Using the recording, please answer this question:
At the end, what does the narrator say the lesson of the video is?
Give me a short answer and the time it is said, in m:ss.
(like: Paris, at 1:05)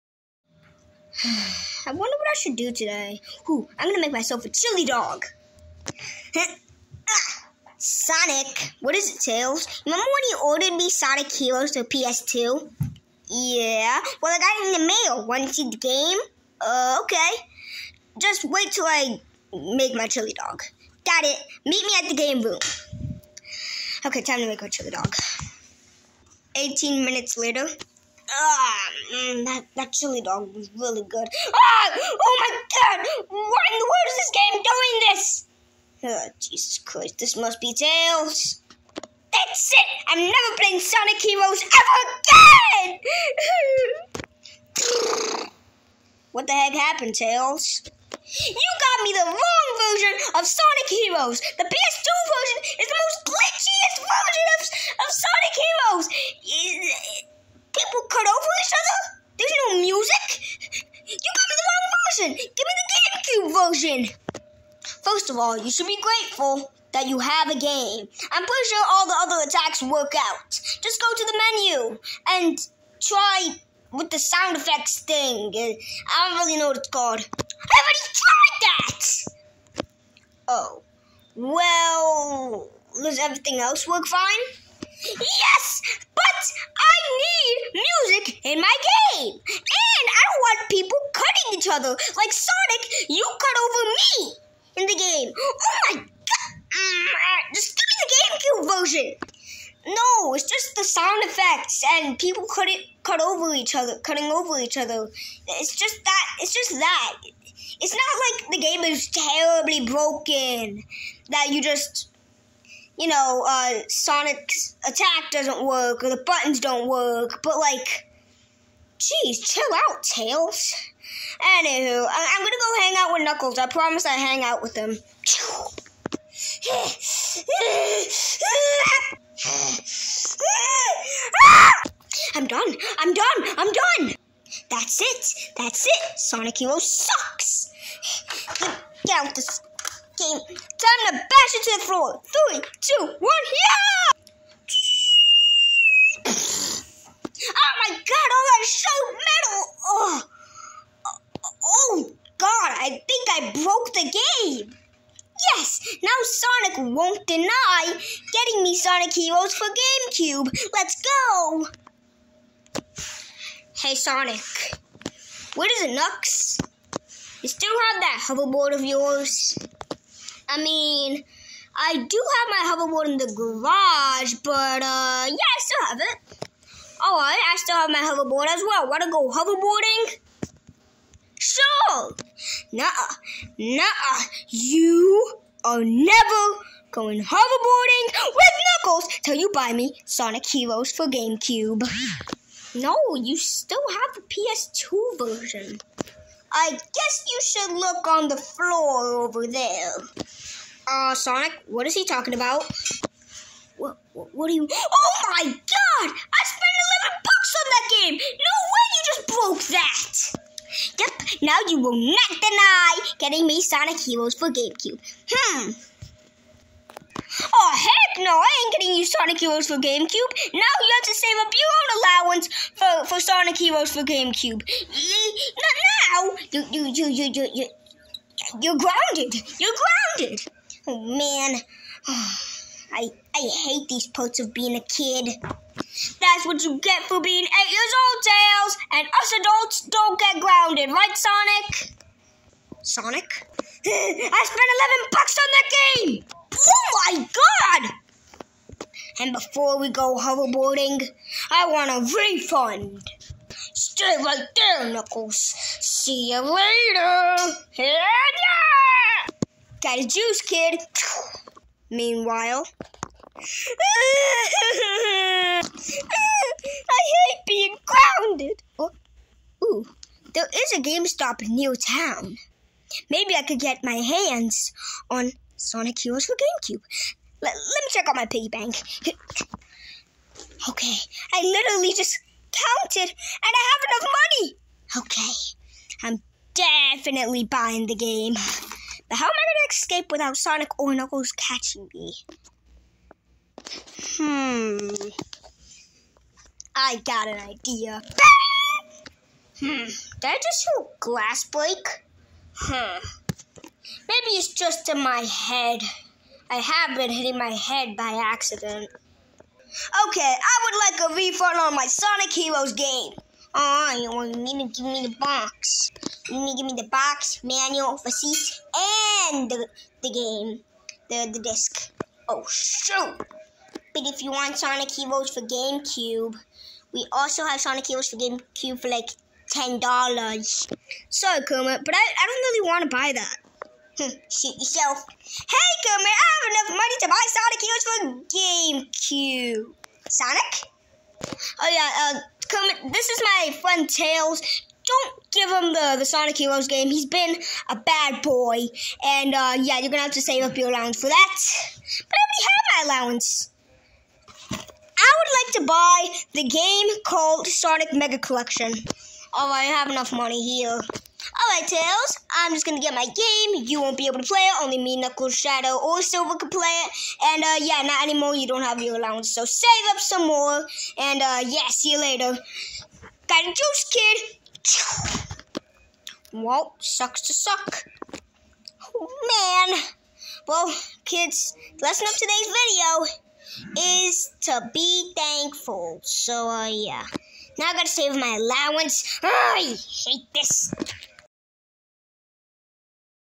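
To be thankful, at 6:24.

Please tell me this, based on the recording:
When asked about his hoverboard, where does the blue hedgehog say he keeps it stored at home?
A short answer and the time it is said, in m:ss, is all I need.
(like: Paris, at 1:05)
The garage, at 2:53.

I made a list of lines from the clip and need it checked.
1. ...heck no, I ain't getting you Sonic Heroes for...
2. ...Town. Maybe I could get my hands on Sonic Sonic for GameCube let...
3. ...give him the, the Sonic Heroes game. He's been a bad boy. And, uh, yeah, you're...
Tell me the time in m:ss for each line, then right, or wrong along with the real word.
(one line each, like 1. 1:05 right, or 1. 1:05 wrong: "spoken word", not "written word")
1. 3:37 right
2. 4:31 wrong: "Heroes", not "Sonic"
3. 5:45 right.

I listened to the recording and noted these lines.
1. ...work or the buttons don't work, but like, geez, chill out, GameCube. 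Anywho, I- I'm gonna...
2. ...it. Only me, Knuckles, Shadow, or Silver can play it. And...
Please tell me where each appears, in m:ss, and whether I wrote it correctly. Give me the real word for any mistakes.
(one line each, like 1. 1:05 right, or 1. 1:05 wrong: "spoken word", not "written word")
1. 1:55 wrong: "Tails", not "GameCube"
2. 6:04 right.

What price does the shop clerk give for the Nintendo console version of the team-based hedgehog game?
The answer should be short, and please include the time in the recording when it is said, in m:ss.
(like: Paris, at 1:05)
$10, at 5:29.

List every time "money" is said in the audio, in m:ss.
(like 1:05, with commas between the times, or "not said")
4:44, 5:36, 6:00.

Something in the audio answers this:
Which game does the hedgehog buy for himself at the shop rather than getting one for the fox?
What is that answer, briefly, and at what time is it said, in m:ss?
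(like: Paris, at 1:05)
Sonic Mega Collection, at 5:57.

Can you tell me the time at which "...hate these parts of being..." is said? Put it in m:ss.
3:53.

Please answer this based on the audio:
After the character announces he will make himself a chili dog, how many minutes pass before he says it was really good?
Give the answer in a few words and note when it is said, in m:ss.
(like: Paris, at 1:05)
18, at 0:26.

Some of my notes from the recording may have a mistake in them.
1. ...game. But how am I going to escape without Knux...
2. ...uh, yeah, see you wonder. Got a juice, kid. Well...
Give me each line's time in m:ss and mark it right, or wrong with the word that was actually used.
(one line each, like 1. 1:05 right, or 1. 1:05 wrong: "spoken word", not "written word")
1. 4:47 wrong: "Sonic", not "Knux"
2. 6:11 wrong: "later", not "wonder".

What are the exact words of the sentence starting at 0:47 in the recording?
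You got me the wrong version of Sonic Heroes!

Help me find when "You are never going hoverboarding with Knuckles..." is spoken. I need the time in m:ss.
3:04.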